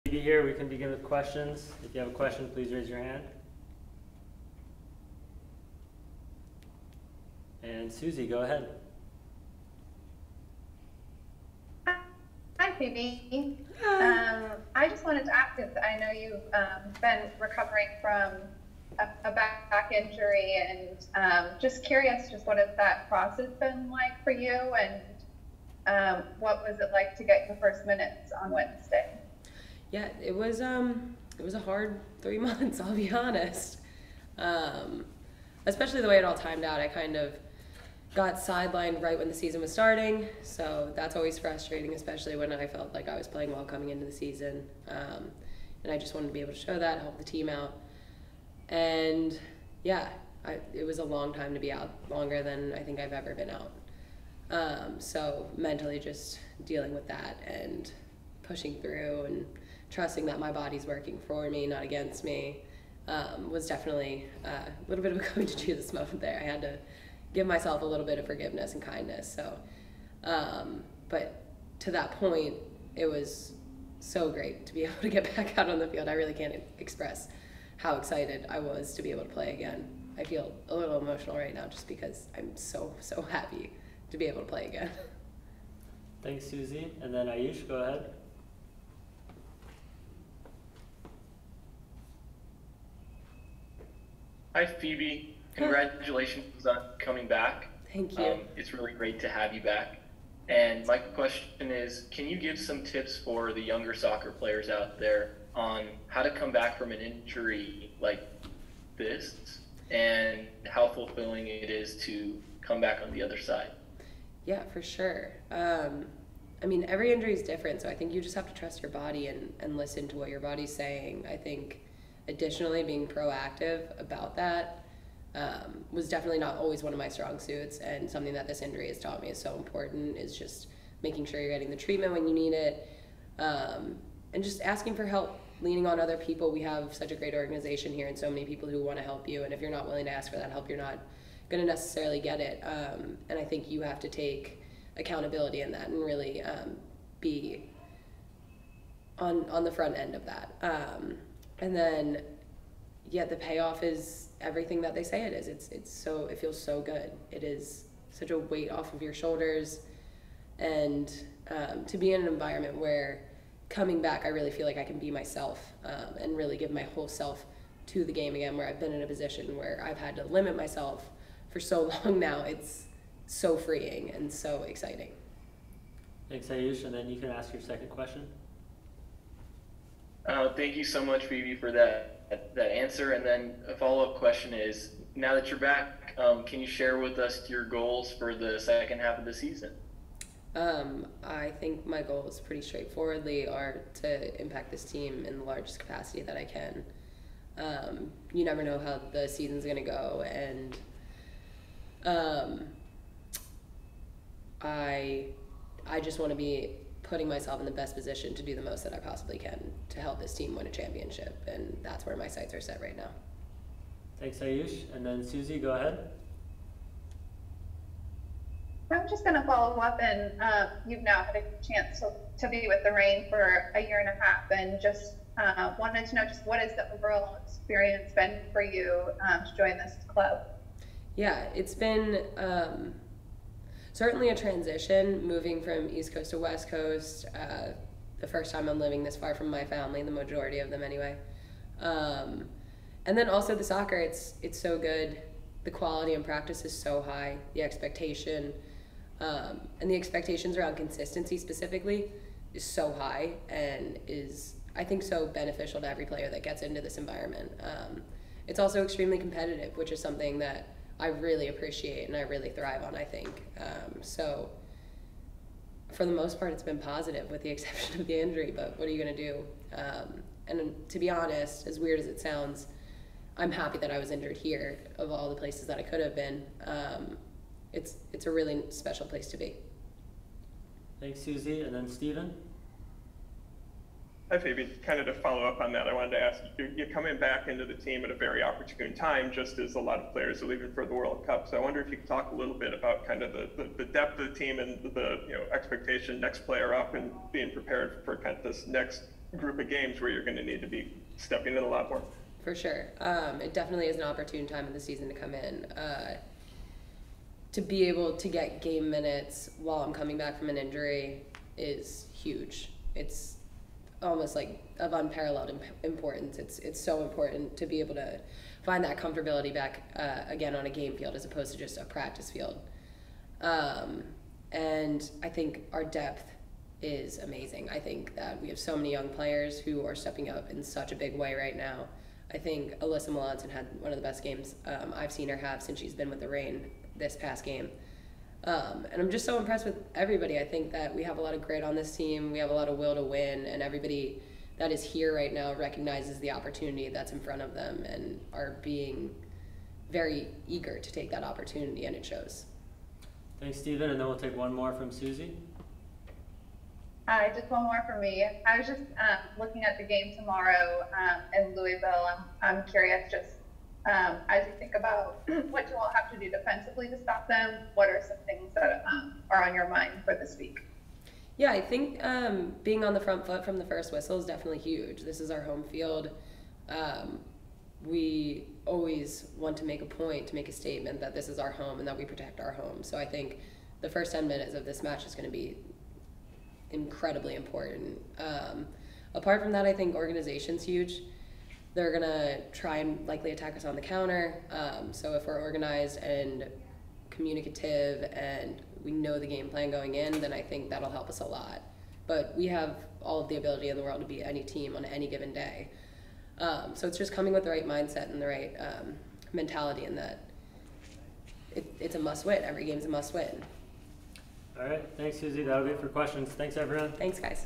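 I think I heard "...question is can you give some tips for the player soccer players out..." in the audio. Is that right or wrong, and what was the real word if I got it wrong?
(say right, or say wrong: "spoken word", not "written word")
wrong: "younger", not "player".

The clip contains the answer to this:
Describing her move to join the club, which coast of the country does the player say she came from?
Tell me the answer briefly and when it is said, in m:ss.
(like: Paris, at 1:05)
East Coast, at 3:55.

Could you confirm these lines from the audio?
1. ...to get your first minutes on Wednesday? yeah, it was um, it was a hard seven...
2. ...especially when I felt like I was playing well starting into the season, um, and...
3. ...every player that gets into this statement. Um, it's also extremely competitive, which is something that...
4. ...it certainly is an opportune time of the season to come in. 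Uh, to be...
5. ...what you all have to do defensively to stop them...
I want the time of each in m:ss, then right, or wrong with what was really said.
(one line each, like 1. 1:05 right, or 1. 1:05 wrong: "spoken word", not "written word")
1. 0:27 wrong: "three", not "seven"
2. 0:41 wrong: "coming", not "starting"
3. 4:15 wrong: "environment", not "statement"
4. 5:03 wrong: "definitely", not "certainly"
5. 6:05 right.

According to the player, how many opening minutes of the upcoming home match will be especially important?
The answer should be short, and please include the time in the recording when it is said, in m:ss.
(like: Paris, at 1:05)
10, at 6:24.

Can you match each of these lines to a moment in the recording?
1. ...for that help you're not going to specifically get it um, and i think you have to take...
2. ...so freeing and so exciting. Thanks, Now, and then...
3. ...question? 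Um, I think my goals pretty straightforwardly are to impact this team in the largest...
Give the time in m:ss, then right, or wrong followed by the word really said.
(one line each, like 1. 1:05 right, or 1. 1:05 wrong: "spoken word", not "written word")
1. 2:20 wrong: "necessarily", not "specifically"
2. 2:53 wrong: "Ayush", not "Now"
3. 3:09 wrong: "season", not "question".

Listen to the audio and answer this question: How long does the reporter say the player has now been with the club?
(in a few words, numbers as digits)
A year and a half.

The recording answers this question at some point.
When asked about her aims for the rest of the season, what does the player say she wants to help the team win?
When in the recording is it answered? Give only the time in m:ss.
3:30.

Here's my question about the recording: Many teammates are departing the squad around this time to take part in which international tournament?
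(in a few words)
World Cup.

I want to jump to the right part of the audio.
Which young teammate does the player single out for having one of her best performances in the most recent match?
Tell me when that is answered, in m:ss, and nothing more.
5:32.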